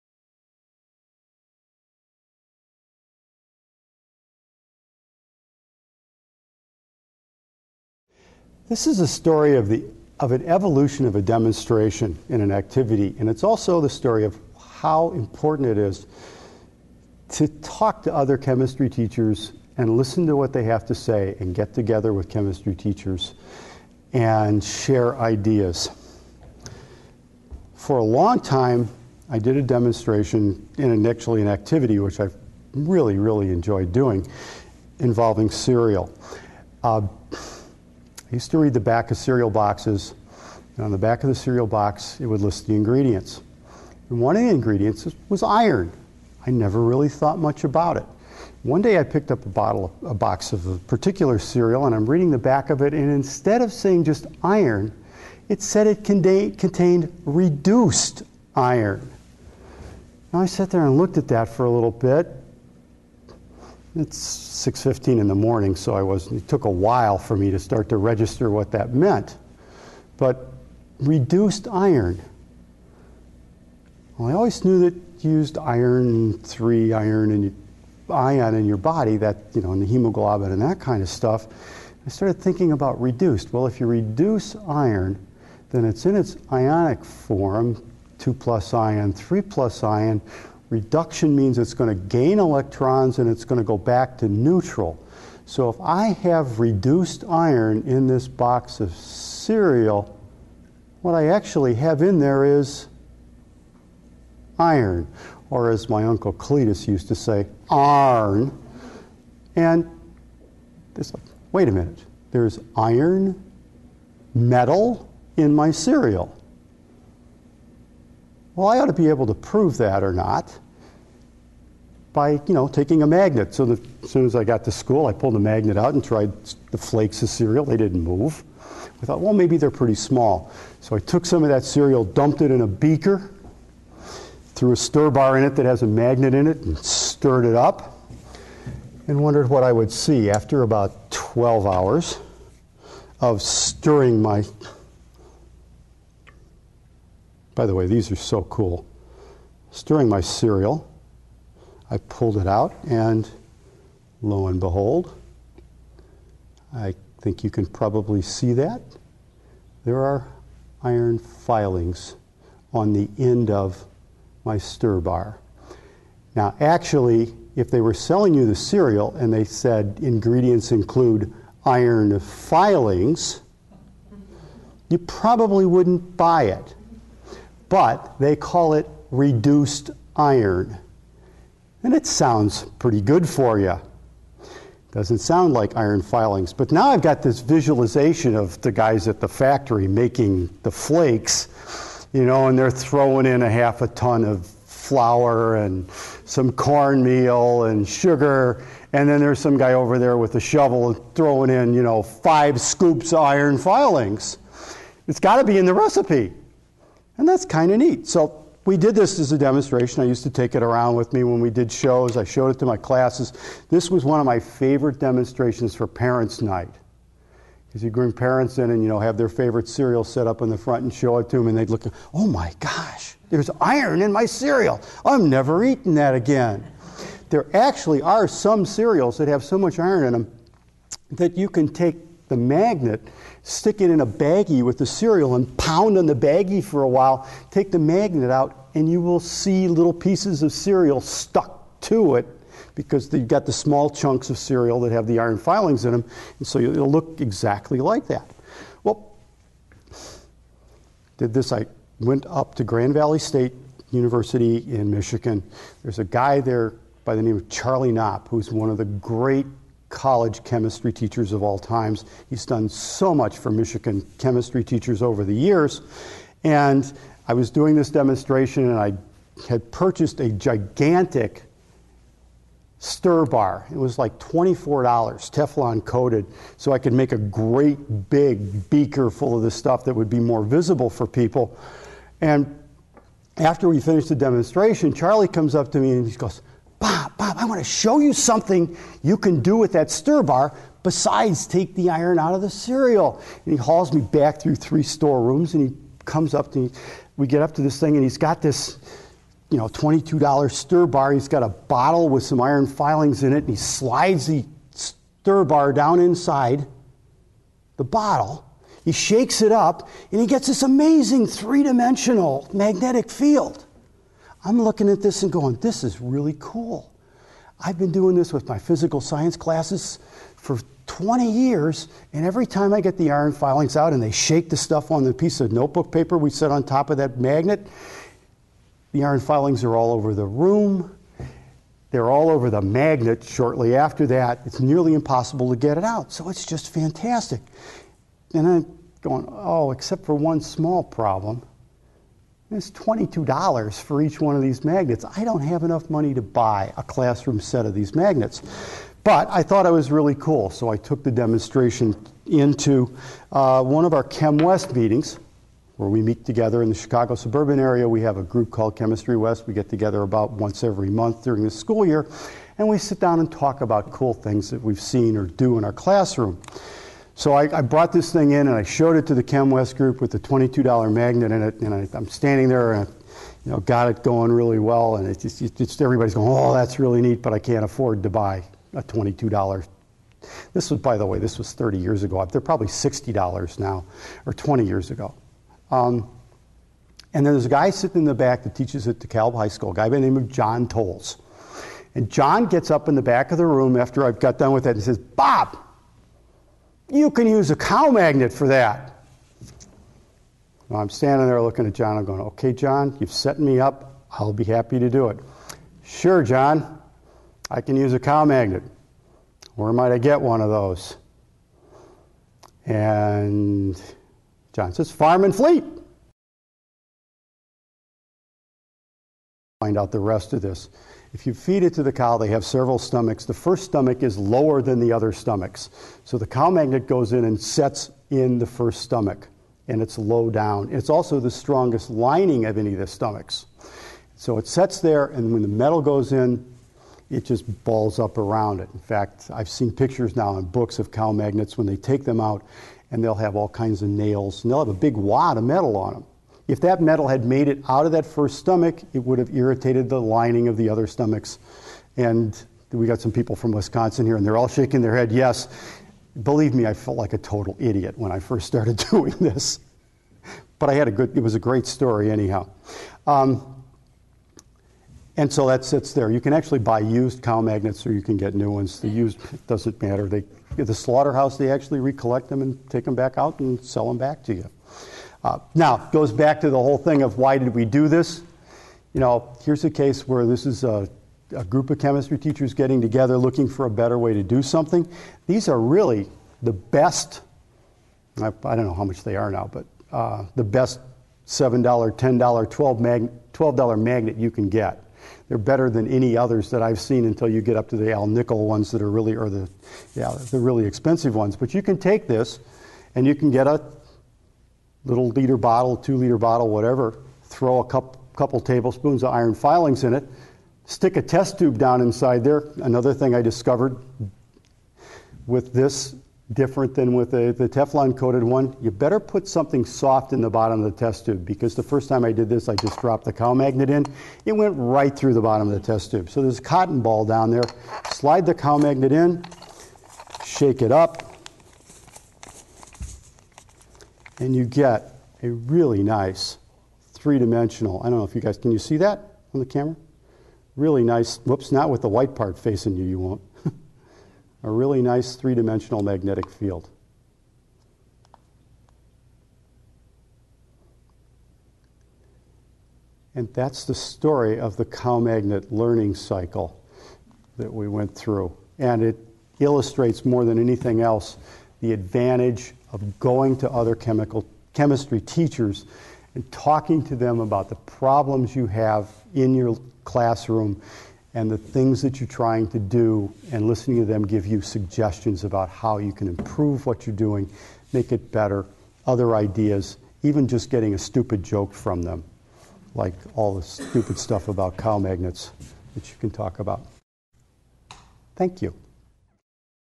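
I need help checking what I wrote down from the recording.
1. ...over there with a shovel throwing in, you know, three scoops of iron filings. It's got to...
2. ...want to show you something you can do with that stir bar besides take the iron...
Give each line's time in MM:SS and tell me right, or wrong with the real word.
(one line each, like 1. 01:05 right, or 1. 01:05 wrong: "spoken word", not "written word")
1. 03:19 wrong: "five", not "three"
2. 04:47 right.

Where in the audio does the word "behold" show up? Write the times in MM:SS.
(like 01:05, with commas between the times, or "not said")
02:34.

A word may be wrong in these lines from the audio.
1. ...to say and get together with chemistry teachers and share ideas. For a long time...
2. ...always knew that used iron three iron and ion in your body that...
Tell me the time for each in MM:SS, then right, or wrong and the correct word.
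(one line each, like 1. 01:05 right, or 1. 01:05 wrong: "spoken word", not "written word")
1. 00:20 right
2. 01:14 right.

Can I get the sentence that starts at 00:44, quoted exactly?
And one of the ingredients was iron.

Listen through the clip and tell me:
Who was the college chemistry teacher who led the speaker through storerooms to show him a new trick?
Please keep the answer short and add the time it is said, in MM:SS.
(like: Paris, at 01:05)
Charlie Knopp, at 04:17.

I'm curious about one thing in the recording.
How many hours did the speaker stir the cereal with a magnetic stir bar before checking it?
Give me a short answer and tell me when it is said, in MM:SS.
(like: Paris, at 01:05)
12, at 02:21.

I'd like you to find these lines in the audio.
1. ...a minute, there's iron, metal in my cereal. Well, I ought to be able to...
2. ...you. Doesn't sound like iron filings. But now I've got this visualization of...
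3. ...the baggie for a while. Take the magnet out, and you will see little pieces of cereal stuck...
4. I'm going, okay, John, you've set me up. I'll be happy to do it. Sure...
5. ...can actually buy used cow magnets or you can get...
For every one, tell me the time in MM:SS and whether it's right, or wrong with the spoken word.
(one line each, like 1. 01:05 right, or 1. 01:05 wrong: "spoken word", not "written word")
1. 01:51 right
2. 03:03 right
3. 03:56 right
4. 06:41 right
5. 07:46 right.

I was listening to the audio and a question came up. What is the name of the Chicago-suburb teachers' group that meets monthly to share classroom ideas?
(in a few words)
Chemistry West.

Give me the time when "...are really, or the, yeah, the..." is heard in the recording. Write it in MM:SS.
08:18.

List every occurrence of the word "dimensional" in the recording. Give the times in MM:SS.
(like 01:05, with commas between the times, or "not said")
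05:11, 08:56, 09:05.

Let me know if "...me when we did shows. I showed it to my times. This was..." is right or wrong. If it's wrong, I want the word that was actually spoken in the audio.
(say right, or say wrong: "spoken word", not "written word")
wrong: "classes", not "times".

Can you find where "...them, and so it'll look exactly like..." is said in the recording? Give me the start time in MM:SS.
04:05.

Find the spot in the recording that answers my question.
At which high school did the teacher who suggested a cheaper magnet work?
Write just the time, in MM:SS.
06:28.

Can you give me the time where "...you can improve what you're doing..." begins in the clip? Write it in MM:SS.
09:35.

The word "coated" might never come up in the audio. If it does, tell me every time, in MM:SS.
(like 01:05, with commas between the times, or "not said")
04:35, 08:37.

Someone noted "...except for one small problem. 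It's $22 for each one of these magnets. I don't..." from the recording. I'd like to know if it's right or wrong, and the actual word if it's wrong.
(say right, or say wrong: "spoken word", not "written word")
right.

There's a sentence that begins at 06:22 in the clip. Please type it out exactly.
They're probably $60 now, or 20 years ago.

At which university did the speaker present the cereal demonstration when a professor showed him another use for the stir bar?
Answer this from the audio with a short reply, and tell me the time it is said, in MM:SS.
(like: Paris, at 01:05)
Grand Valley State University, at 04:12.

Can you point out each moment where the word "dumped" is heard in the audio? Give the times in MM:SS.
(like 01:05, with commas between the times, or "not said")
02:12.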